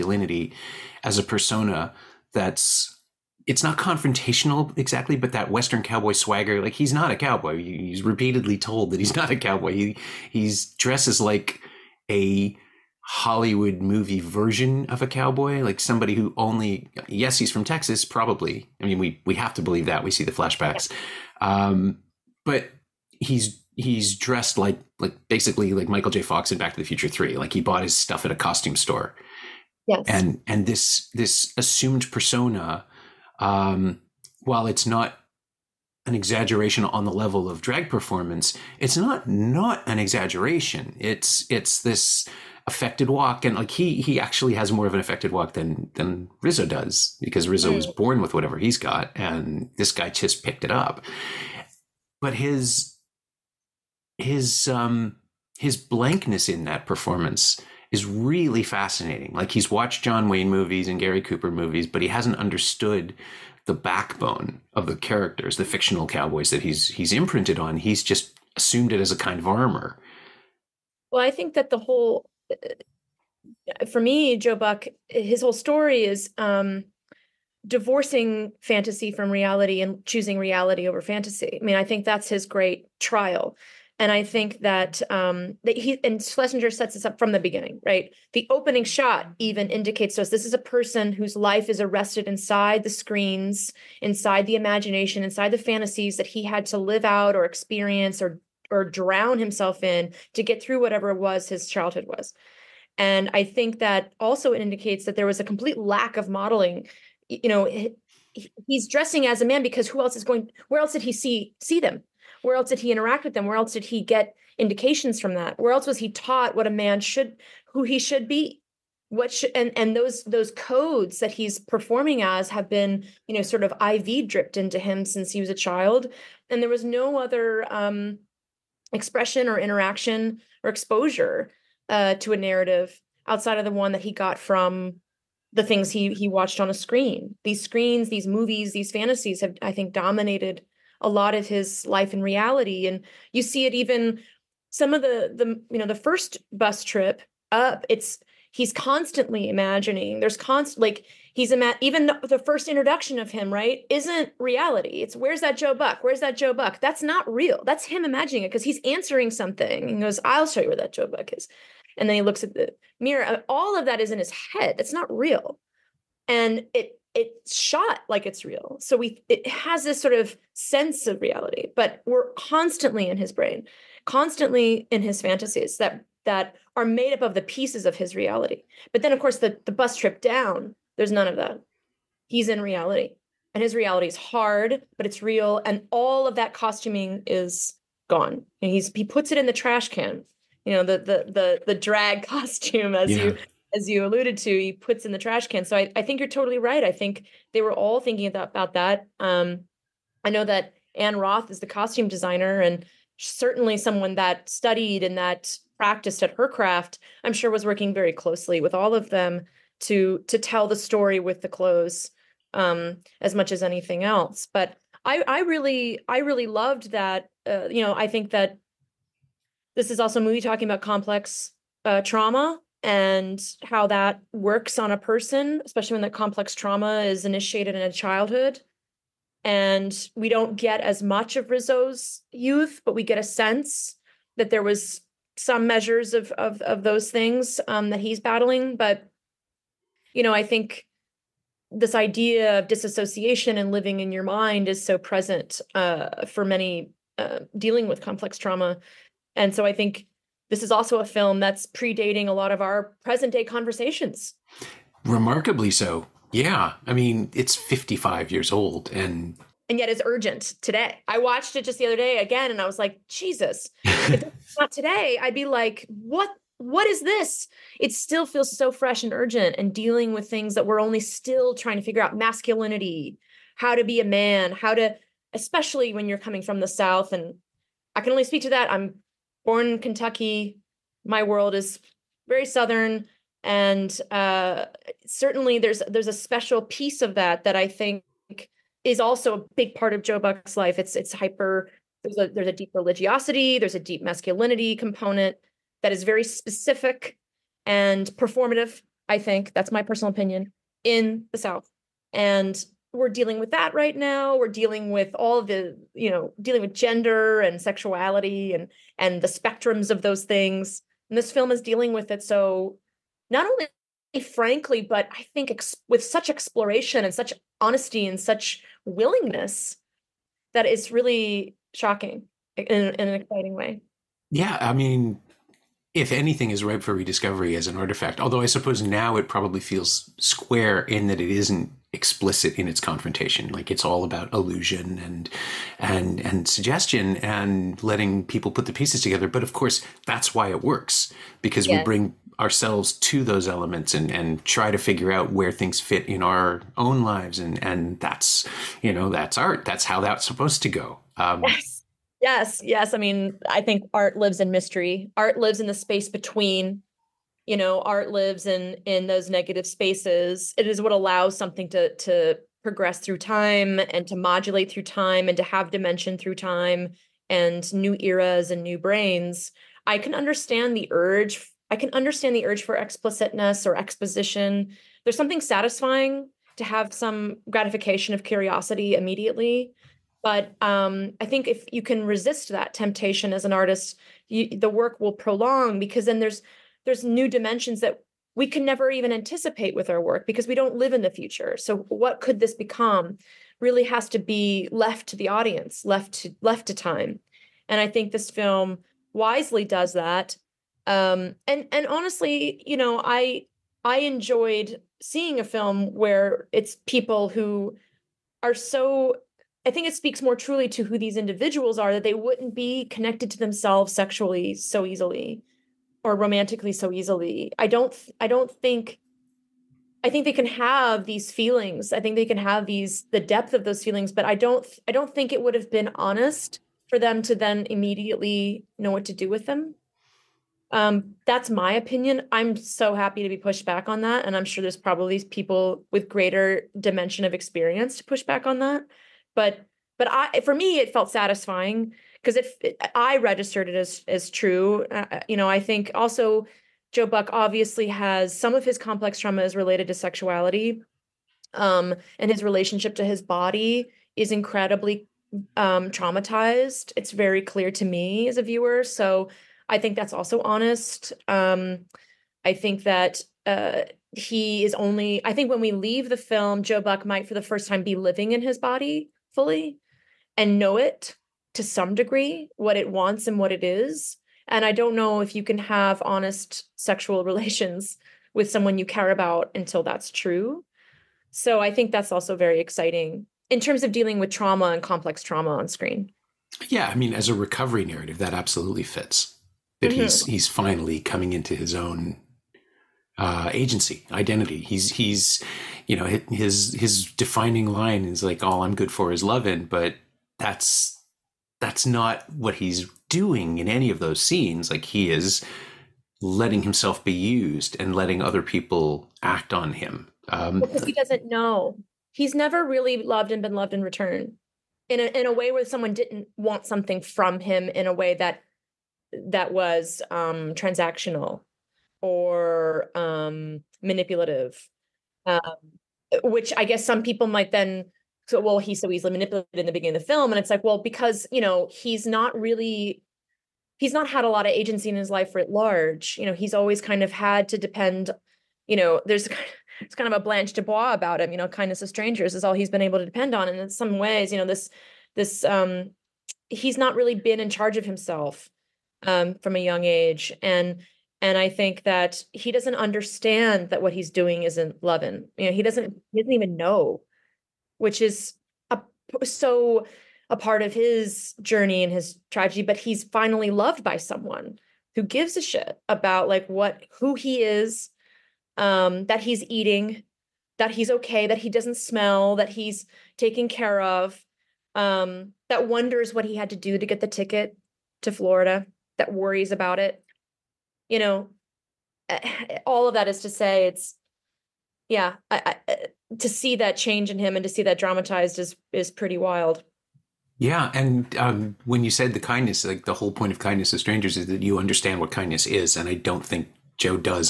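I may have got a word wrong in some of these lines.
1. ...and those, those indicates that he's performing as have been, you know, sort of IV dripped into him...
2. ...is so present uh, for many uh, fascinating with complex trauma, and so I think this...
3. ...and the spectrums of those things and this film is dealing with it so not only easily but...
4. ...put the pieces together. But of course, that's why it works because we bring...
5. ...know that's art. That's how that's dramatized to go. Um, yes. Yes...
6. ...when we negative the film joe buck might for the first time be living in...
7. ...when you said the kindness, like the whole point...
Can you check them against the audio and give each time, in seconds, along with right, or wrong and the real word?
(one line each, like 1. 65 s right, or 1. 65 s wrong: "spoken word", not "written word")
1. 119 s wrong: "codes", not "indicates"
2. 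244 s wrong: "dealing", not "fascinating"
3. 308 s wrong: "frankly", not "easily"
4. 338 s right
5. 348 s wrong: "supposed", not "dramatized"
6. 465 s wrong: "leave", not "negative"
7. 591 s right.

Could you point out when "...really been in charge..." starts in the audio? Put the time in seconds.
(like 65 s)
546 s.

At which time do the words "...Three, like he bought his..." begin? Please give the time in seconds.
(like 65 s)
27 s.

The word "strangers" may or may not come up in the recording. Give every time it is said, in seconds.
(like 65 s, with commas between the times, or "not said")
541 s, 593 s.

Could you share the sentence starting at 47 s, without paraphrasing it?
born with whatever he's got, and this guy just picked it up.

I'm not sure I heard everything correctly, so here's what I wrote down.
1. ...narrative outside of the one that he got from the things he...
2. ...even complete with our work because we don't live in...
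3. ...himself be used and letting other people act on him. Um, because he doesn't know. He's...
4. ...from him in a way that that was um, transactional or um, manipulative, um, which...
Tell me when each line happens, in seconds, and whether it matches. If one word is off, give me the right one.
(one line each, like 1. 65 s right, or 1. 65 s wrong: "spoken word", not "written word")
1. 132 s right
2. 388 s wrong: "anticipate", not "complete"
3. 506 s right
4. 517 s right.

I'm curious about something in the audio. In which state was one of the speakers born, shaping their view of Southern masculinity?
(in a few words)
Kentucky.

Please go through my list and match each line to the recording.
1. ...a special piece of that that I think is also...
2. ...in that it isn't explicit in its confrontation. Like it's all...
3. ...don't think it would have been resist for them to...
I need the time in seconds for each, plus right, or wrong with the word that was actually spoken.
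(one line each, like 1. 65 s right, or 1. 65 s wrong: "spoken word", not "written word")
1. 286 s right
2. 330 s right
3. 424 s wrong: "honest", not "resist".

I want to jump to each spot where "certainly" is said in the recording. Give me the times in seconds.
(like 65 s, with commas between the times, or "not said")
203 s, 285 s.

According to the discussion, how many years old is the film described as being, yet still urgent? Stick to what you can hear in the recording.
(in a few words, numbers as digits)
55.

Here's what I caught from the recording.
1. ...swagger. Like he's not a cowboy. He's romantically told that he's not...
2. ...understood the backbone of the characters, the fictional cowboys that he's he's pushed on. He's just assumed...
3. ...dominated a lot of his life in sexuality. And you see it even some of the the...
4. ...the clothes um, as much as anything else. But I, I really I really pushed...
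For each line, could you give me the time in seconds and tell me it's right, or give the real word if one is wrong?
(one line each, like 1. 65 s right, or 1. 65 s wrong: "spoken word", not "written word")
1. 6 s wrong: "repeatedly", not "romantically"
2. 62 s wrong: "imprinted", not "pushed"
3. 139 s wrong: "reality", not "sexuality"
4. 211 s wrong: "loved", not "pushed".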